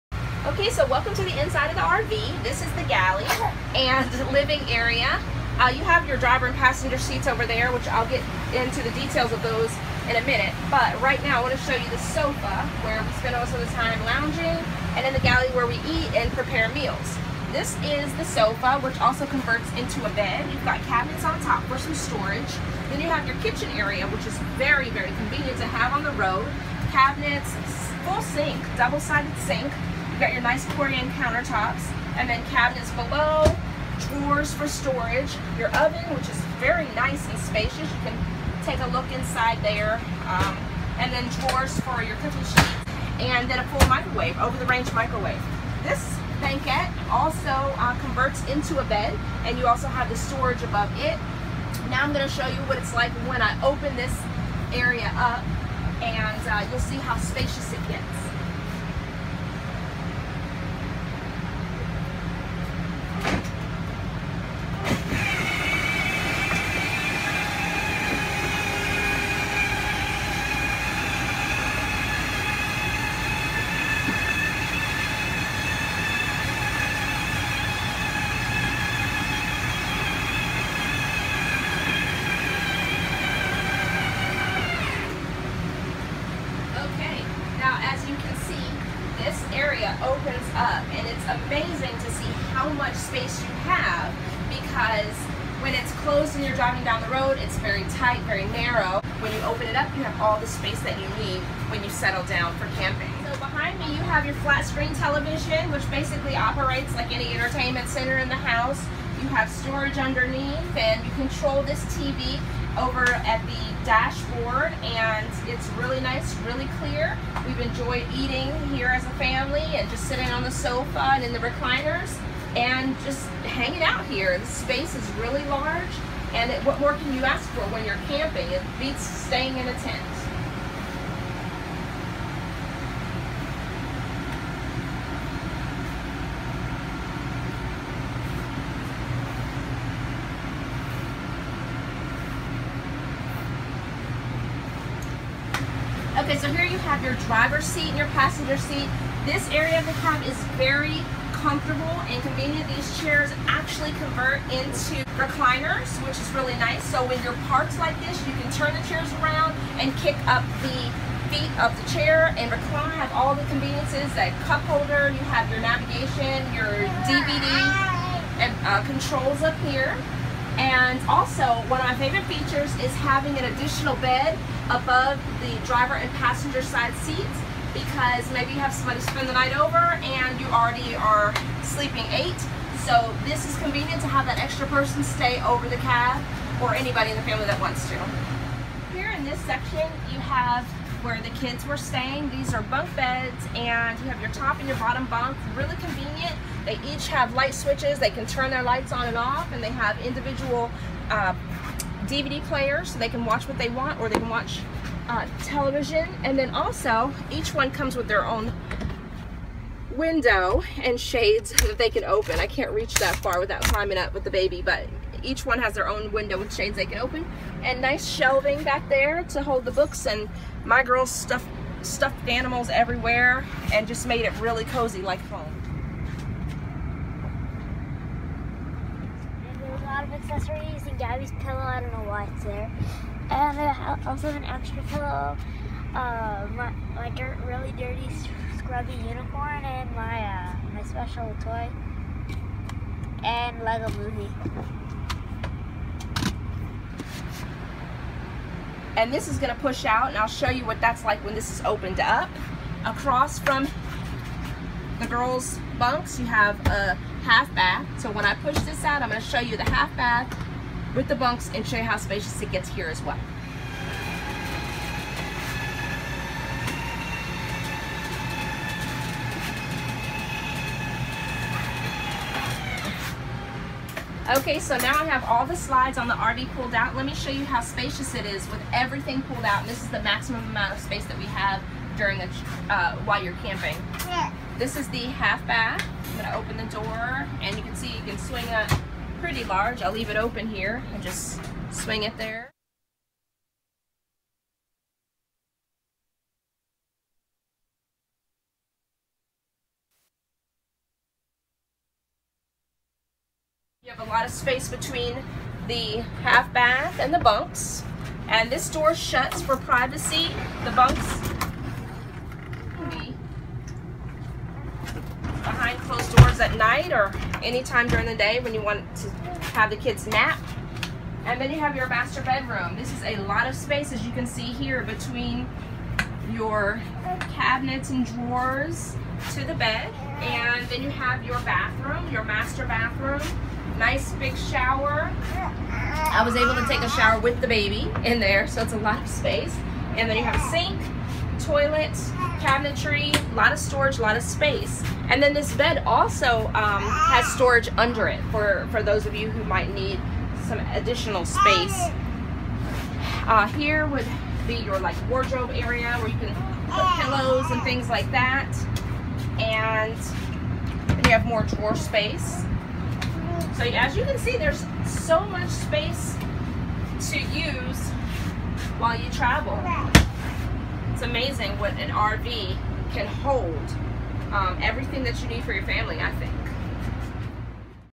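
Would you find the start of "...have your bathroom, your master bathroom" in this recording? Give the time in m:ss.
5:30.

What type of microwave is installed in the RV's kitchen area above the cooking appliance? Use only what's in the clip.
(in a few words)
over-the-range microwave.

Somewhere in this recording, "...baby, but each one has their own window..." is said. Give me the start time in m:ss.
3:34.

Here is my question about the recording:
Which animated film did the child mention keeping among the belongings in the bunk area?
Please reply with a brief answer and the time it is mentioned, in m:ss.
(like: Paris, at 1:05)
Lego movie, at 4:03.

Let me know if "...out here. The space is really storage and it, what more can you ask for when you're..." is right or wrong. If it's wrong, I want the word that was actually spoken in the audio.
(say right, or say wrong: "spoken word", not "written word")
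wrong: "large", not "storage".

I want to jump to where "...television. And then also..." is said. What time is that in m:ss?
3:25.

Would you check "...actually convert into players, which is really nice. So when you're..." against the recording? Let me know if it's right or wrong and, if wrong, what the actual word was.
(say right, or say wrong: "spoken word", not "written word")
wrong: "recliners", not "players".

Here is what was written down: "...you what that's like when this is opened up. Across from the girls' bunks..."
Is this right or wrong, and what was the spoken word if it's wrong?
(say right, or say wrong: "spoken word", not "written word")
right.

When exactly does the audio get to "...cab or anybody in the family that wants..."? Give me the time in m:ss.
3:05.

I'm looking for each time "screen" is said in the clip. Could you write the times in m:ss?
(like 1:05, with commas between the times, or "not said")
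1:44.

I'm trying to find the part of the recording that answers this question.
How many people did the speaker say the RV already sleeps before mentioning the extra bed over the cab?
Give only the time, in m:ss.
3:02.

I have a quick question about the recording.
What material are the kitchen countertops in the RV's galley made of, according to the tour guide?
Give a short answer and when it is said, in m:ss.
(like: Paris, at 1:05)
Corian, at 0:30.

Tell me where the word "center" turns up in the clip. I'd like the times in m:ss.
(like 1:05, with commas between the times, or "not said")
1:47.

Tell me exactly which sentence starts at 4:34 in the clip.
Okay, so now I have all the slides on the RV pulled out.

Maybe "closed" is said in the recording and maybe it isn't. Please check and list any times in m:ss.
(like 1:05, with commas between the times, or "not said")
1:36, 5:15.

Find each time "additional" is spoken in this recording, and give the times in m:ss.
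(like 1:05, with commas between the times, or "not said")
2:53, 5:50.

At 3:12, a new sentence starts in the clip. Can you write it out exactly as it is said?
These are bunk beds and you have your top and your bottom bunk.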